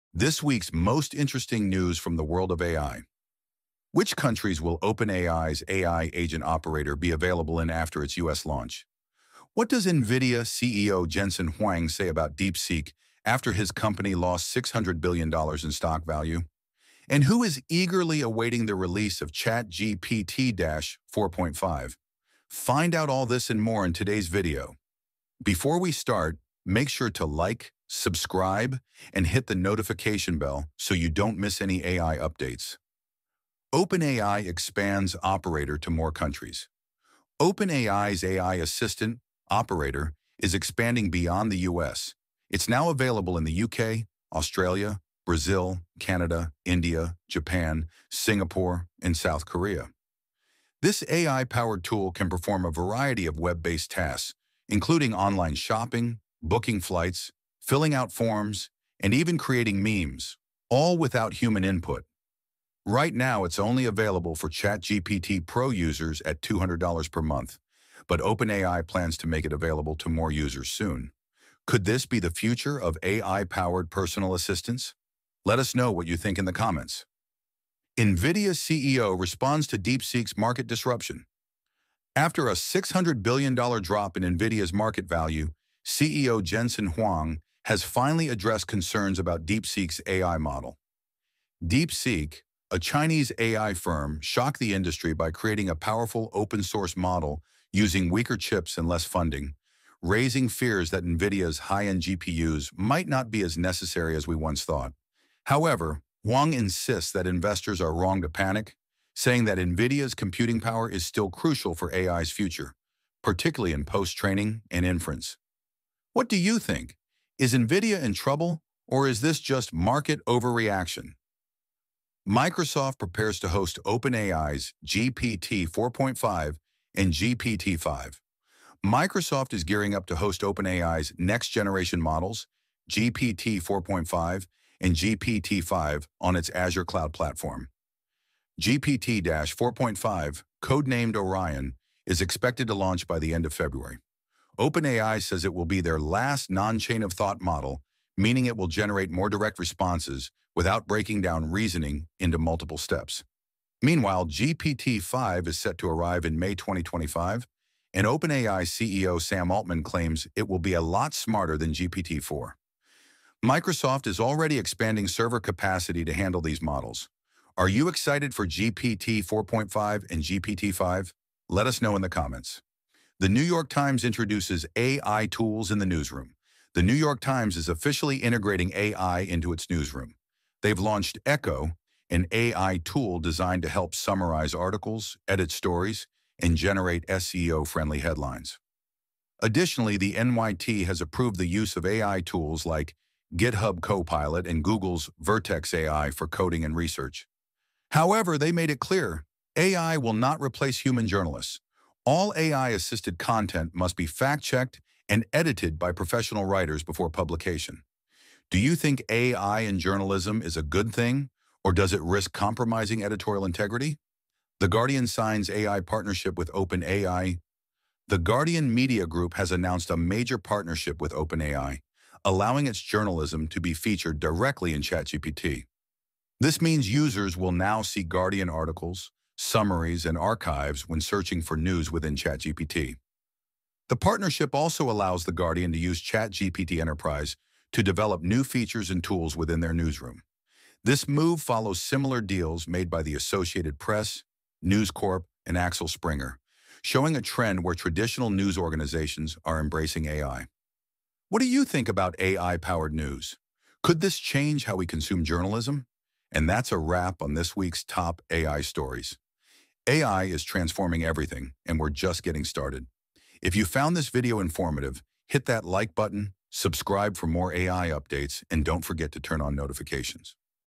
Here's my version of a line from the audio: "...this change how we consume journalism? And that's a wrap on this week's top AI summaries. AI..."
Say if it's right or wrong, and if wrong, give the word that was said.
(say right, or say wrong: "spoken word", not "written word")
wrong: "stories", not "summaries".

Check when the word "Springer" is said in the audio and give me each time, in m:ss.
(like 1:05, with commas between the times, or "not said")
4:05.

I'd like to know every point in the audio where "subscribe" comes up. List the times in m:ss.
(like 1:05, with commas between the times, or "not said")
0:27, 4:26.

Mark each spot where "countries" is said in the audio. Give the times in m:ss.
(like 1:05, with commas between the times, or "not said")
0:04, 0:36.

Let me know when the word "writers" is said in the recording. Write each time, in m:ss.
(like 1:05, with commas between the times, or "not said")
3:26.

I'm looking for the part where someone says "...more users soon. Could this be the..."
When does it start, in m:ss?
1:10.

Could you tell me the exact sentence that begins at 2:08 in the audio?
Microsoft is gearing up to host OpenAI's next-generation models, GPT 4.5 and GPT-5, on its Azure cloud platform.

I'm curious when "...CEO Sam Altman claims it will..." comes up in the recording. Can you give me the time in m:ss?
2:38.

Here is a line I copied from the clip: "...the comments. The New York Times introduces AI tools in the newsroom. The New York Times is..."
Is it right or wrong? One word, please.
right.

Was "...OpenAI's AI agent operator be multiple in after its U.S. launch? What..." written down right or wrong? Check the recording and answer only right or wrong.
wrong.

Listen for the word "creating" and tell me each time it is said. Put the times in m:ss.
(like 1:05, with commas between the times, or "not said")
0:59, 1:35.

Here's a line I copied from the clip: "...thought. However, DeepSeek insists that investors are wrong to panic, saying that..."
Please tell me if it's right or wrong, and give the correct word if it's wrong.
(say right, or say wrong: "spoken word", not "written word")
wrong: "Huang", not "DeepSeek".